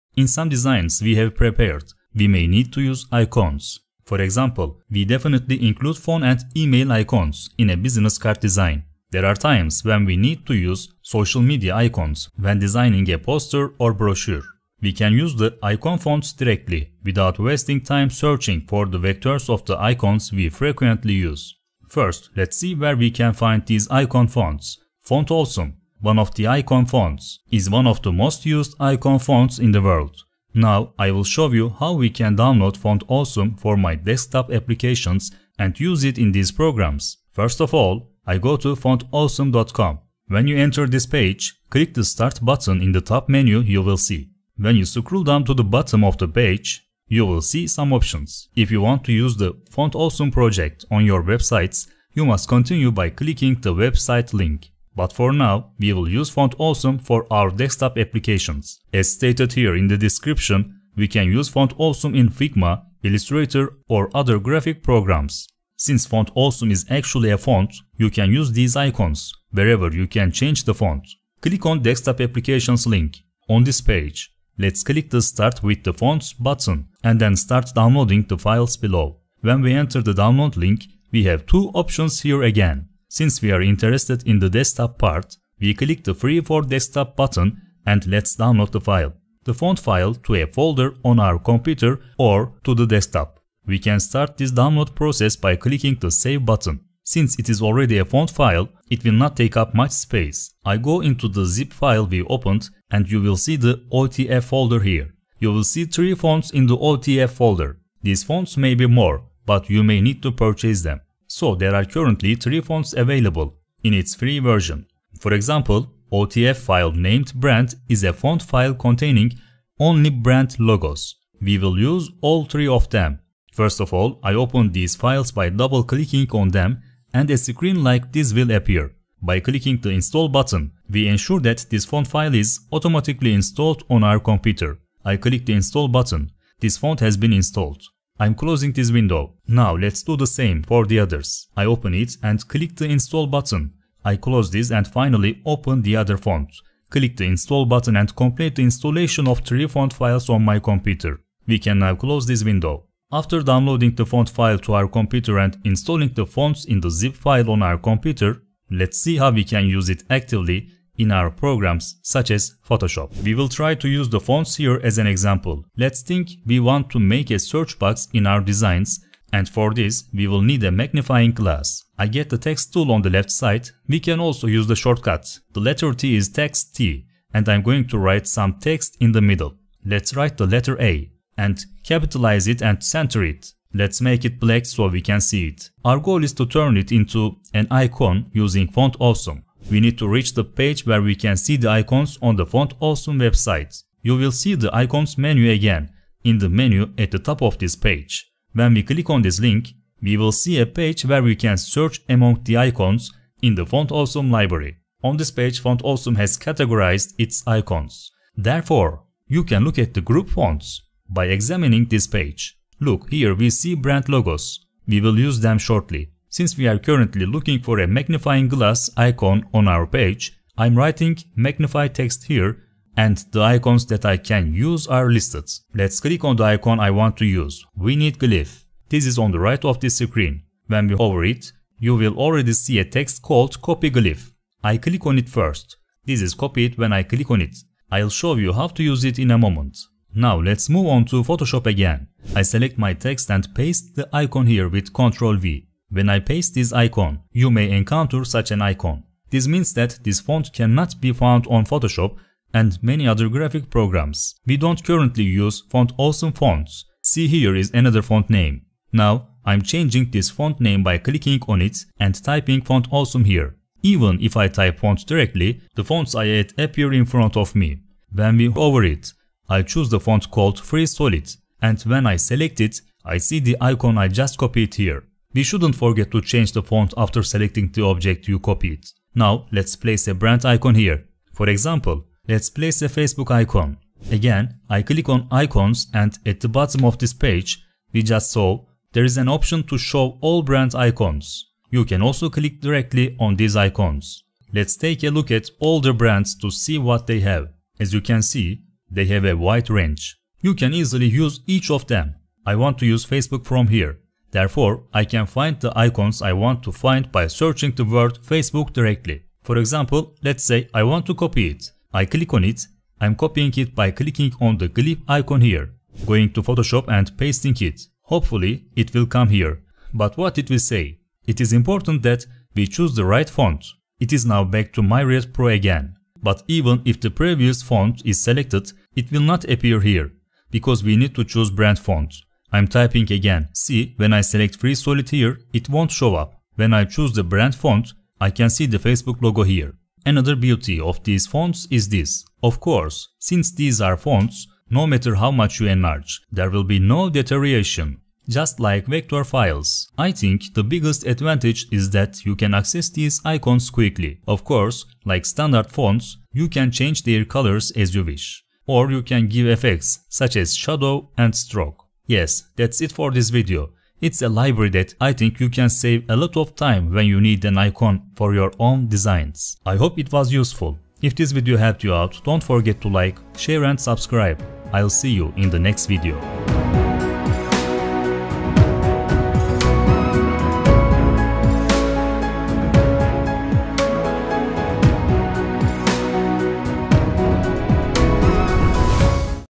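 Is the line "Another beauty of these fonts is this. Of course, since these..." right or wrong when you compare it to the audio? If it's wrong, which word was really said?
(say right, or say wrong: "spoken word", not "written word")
right.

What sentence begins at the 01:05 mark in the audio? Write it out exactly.
Since Font Awesome is actually a font, you can use these icons, wherever you can change the font.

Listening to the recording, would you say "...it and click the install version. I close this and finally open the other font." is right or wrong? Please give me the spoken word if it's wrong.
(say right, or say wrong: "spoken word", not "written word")
wrong: "button", not "version".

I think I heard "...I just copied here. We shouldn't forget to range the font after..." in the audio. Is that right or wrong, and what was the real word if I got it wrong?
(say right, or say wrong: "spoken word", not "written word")
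wrong: "change", not "range".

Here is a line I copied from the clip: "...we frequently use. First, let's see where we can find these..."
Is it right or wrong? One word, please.
right.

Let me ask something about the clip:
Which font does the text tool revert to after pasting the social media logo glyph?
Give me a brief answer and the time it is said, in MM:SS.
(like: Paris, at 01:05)
Myriad Pro, at 05:24.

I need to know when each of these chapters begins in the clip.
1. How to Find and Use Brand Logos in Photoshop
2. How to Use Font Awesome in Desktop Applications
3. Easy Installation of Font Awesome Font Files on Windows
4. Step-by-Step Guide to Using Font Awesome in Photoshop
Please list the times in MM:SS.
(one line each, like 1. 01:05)
1. 04:35
2. 00:21
3. 01:36
4. 02:33.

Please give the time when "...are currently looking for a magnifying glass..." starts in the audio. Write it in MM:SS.
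03:36.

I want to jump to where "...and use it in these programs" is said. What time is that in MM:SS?
00:35.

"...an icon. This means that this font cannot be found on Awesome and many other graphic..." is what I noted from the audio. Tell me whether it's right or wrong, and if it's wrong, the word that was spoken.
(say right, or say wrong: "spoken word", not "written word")
wrong: "Photoshop", not "Awesome".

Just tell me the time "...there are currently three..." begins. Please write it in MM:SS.
01:51.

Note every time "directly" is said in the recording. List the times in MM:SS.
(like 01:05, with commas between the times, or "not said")
00:16, 04:25, 04:52, 05:08.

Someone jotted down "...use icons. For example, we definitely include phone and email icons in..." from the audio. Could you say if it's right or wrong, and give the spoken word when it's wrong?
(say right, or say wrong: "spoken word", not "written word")
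right.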